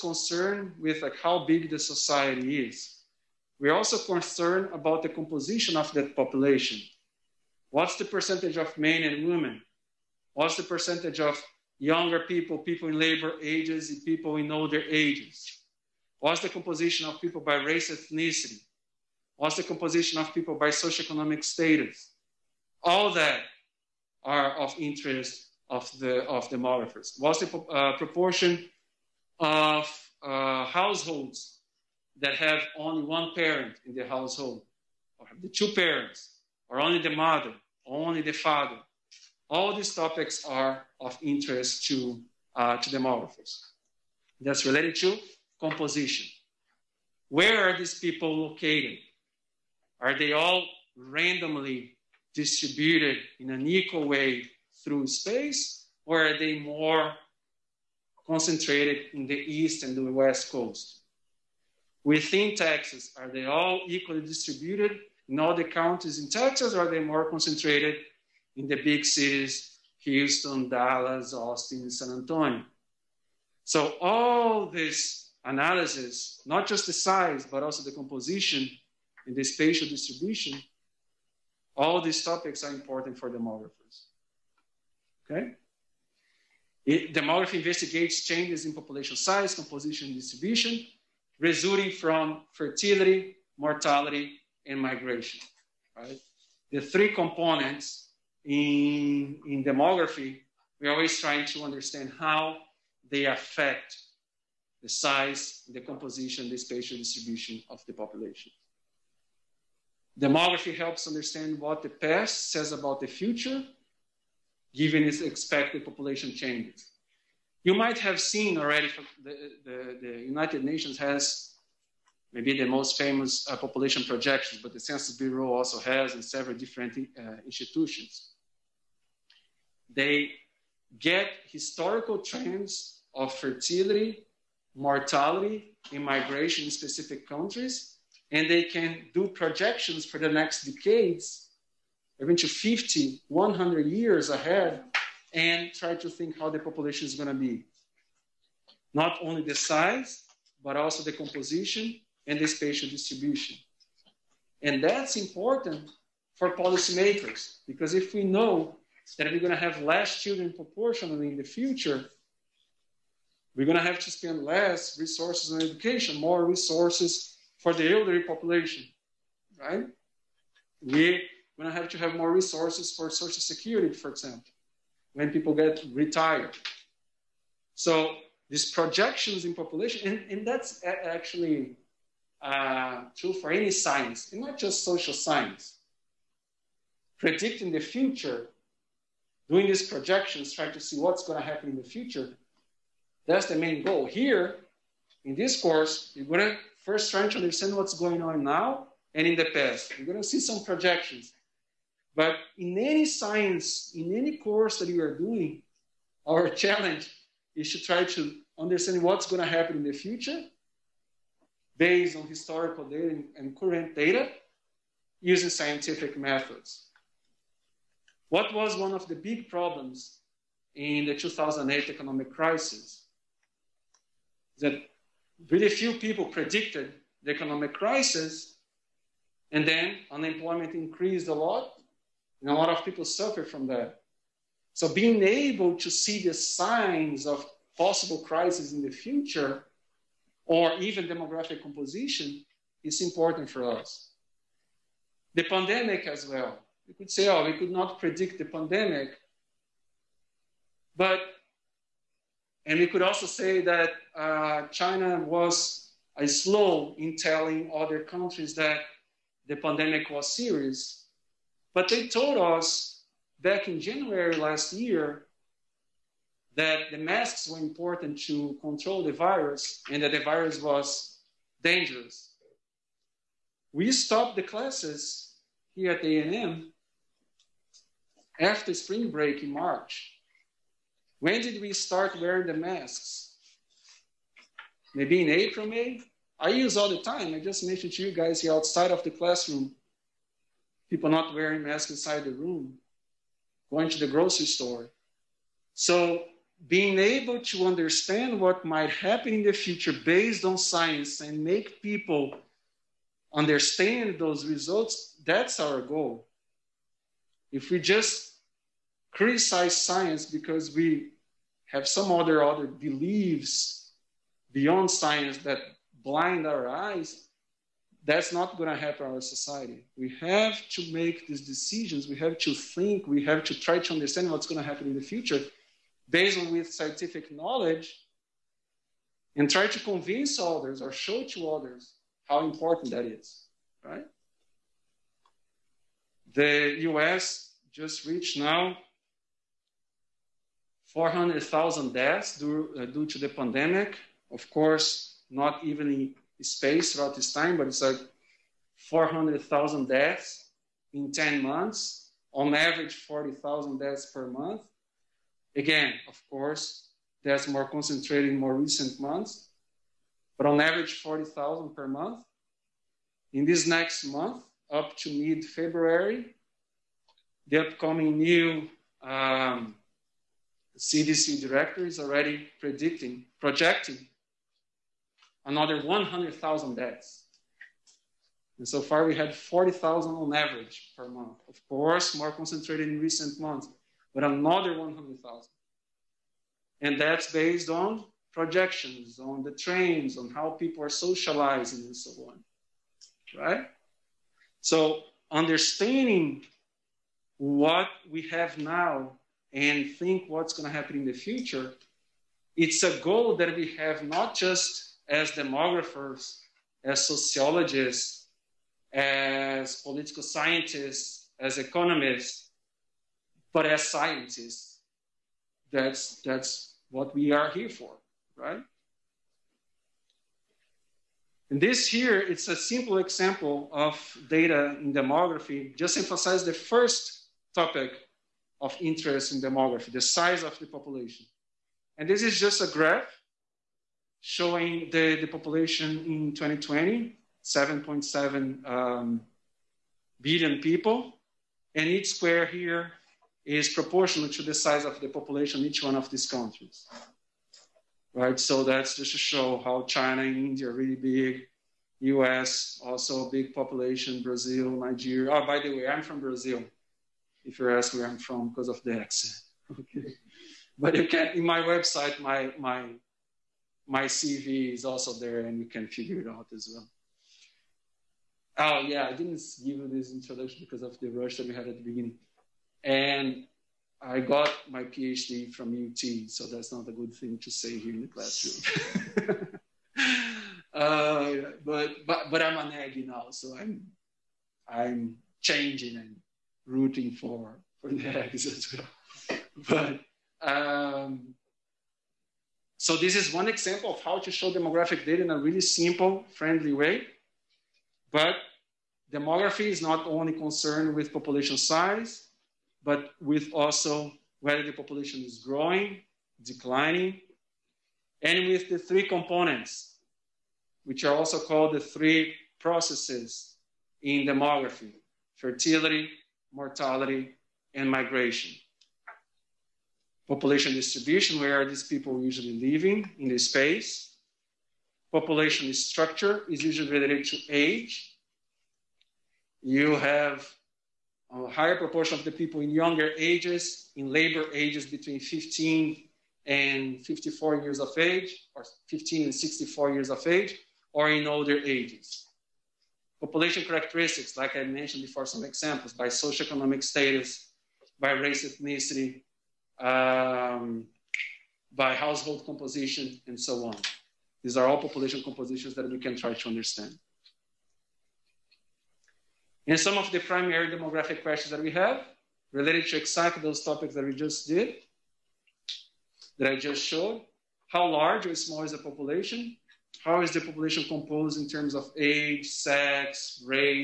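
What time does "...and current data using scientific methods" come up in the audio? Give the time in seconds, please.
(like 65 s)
213 s.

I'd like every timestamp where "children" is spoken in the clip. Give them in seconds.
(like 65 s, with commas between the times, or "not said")
160 s.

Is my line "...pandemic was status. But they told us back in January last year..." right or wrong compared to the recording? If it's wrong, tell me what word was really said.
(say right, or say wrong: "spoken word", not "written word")
wrong: "serious", not "status".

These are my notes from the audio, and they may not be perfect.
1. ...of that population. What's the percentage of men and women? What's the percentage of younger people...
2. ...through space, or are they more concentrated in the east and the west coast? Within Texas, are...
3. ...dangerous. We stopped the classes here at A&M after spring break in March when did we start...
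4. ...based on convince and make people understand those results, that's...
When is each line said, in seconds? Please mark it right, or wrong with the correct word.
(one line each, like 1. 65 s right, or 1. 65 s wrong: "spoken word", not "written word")
1. 5 s right
2. 54 s right
3. 271 s right
4. 299 s wrong: "science", not "convince".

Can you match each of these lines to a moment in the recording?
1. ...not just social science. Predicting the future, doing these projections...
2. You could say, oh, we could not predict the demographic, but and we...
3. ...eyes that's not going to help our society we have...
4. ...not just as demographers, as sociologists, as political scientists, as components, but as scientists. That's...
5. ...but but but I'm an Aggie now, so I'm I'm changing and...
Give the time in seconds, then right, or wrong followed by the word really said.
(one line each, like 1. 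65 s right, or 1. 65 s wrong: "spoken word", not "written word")
1. 184 s right
2. 246 s wrong: "pandemic", not "demographic"
3. 316 s right
4. 404 s wrong: "economists", not "components"
5. 481 s right.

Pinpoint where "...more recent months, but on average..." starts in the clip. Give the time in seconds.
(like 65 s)
358 s.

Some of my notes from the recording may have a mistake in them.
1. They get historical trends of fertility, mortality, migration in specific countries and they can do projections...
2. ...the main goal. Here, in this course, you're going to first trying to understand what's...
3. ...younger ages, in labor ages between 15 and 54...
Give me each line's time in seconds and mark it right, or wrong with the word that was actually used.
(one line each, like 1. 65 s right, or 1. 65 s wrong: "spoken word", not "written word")
1. 129 s wrong: "immigration", not "migration"
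2. 193 s right
3. 532 s right.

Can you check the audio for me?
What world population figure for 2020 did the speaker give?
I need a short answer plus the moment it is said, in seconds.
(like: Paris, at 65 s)
7.7 billion, at 437 s.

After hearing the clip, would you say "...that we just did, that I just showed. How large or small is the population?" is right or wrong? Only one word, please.
right.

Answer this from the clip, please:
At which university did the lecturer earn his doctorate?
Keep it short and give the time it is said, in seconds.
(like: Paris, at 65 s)
UT, at 475 s.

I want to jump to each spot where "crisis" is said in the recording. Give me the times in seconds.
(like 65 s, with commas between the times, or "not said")
222 s, 227 s, 238 s.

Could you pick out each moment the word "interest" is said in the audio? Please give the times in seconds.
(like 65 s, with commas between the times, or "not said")
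24 s, 41 s, 428 s.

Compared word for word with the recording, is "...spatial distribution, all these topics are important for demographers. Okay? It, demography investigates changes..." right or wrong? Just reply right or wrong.
right.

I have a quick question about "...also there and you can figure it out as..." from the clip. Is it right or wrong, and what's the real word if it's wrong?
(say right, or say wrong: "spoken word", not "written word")
right.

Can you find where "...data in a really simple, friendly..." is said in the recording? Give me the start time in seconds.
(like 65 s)
495 s.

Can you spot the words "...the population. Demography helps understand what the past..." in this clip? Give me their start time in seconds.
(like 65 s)
107 s.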